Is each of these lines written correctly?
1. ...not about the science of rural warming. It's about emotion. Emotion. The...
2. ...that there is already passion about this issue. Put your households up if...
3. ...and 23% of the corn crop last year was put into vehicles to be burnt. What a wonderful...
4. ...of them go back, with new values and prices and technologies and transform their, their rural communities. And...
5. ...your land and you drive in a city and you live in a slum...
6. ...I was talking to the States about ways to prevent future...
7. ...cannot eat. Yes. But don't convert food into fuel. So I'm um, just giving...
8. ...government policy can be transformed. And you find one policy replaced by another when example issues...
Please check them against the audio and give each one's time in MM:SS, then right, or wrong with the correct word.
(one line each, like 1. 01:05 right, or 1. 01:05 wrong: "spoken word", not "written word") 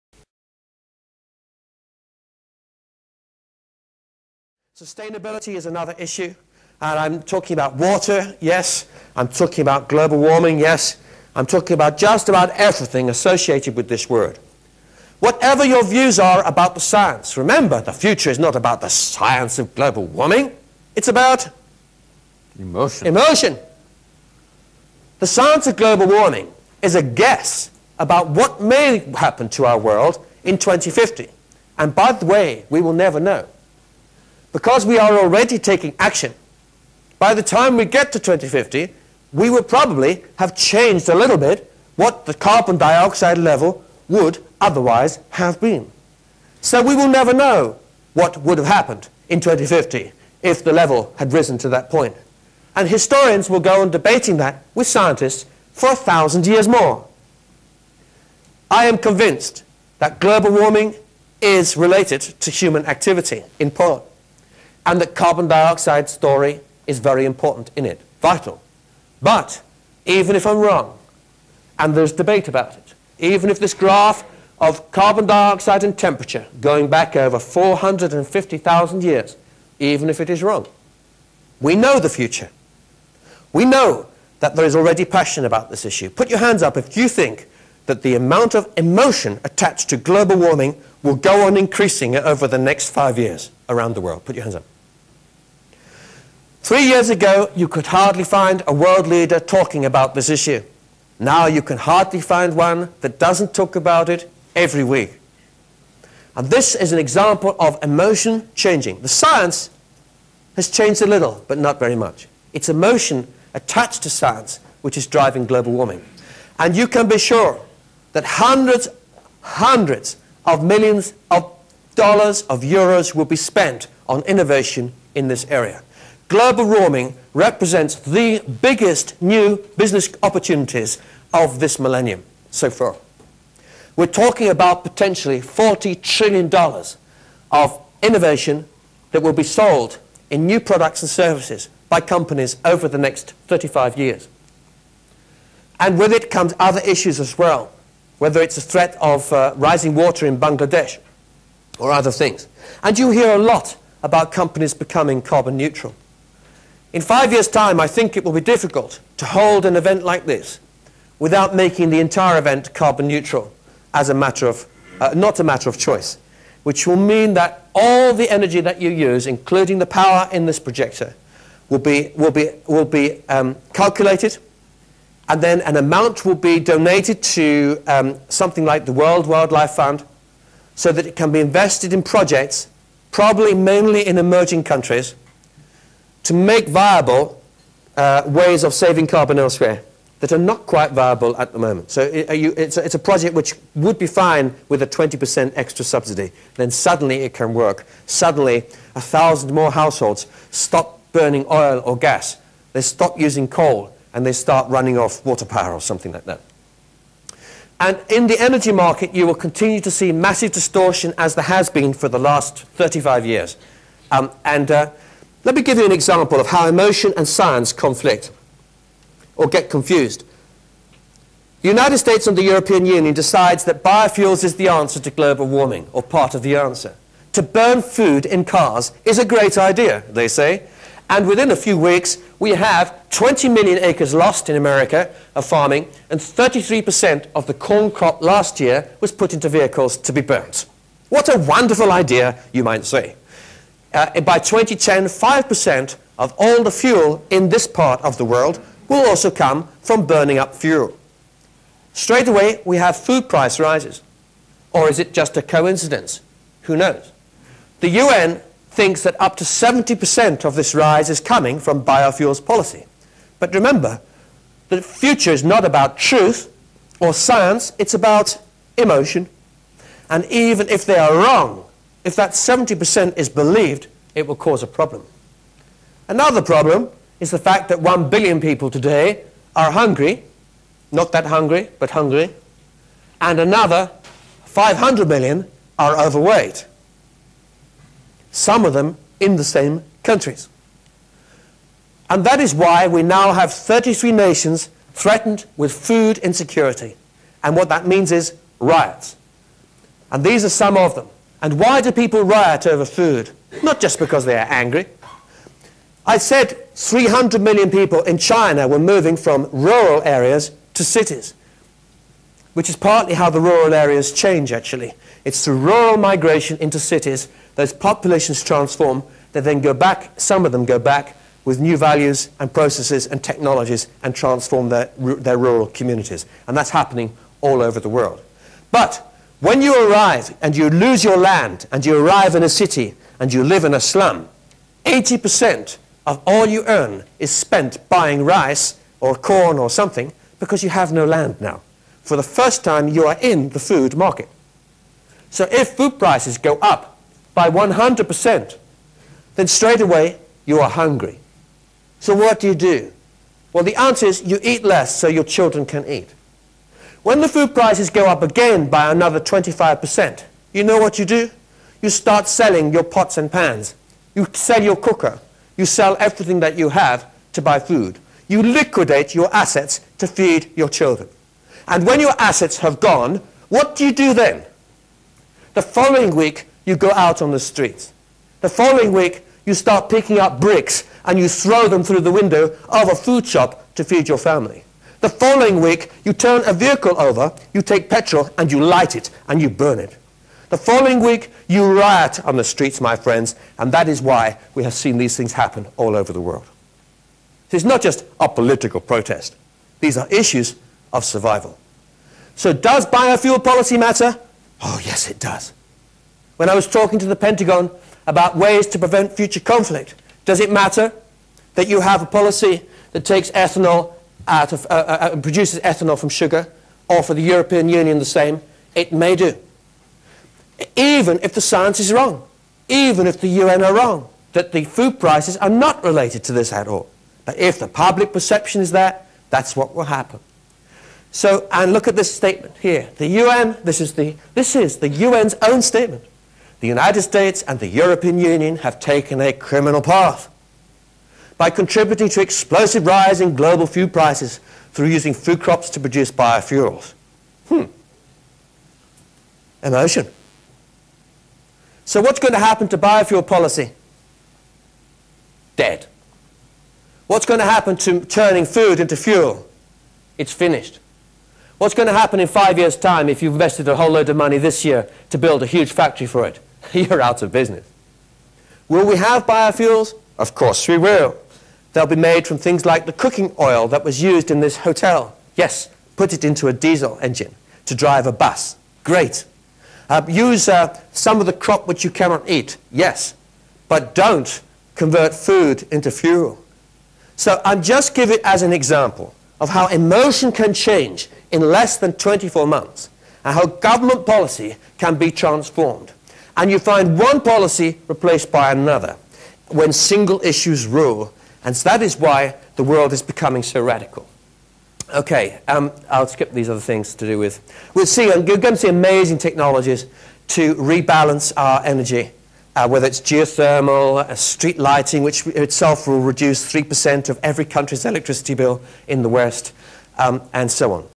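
1. 00:18 wrong: "global", not "rural"
2. 01:24 wrong: "hands", not "households"
3. 03:56 wrong: "33", not "23"
4. 05:20 wrong: "processes", not "prices"
5. 05:31 wrong: "arrive", not "drive"
6. 06:46 wrong: "Pentagon", not "States"
7. 08:01 right
8. 08:13 wrong: "single", not "example".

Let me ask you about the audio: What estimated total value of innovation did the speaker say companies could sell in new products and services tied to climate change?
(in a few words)
$40 trillion.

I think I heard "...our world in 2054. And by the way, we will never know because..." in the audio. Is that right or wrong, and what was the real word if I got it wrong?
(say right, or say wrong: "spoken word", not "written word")
wrong: "2050", not "2054".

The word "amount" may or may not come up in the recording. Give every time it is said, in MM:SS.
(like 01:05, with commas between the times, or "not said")
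01:28, 02:55.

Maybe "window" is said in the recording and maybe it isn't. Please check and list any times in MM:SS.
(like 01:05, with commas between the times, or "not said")
06:22.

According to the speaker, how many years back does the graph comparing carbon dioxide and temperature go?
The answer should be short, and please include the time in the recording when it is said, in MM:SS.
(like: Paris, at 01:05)
450,000 years, at 01:17.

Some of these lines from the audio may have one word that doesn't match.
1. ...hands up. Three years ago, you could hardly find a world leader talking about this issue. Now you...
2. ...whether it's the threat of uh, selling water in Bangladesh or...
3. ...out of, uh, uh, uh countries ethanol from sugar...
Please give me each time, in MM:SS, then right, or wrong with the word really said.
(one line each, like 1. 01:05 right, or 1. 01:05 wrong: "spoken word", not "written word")
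1. 01:34 right
2. 02:28 wrong: "rising", not "selling"
3. 06:54 wrong: "produces", not "countries".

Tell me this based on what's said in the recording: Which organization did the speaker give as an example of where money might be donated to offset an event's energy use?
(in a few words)
World Wildlife Fund.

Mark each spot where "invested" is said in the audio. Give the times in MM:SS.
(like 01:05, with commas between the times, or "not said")
03:01, 07:43.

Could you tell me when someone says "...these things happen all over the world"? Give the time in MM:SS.
06:34.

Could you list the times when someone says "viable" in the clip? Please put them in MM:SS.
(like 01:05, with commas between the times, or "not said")
03:06, 03:10.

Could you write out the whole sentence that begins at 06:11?
And when your assets have gone, what do you do then?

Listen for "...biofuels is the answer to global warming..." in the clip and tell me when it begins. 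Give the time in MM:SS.
03:43.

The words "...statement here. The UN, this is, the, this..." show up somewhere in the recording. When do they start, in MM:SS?
07:12.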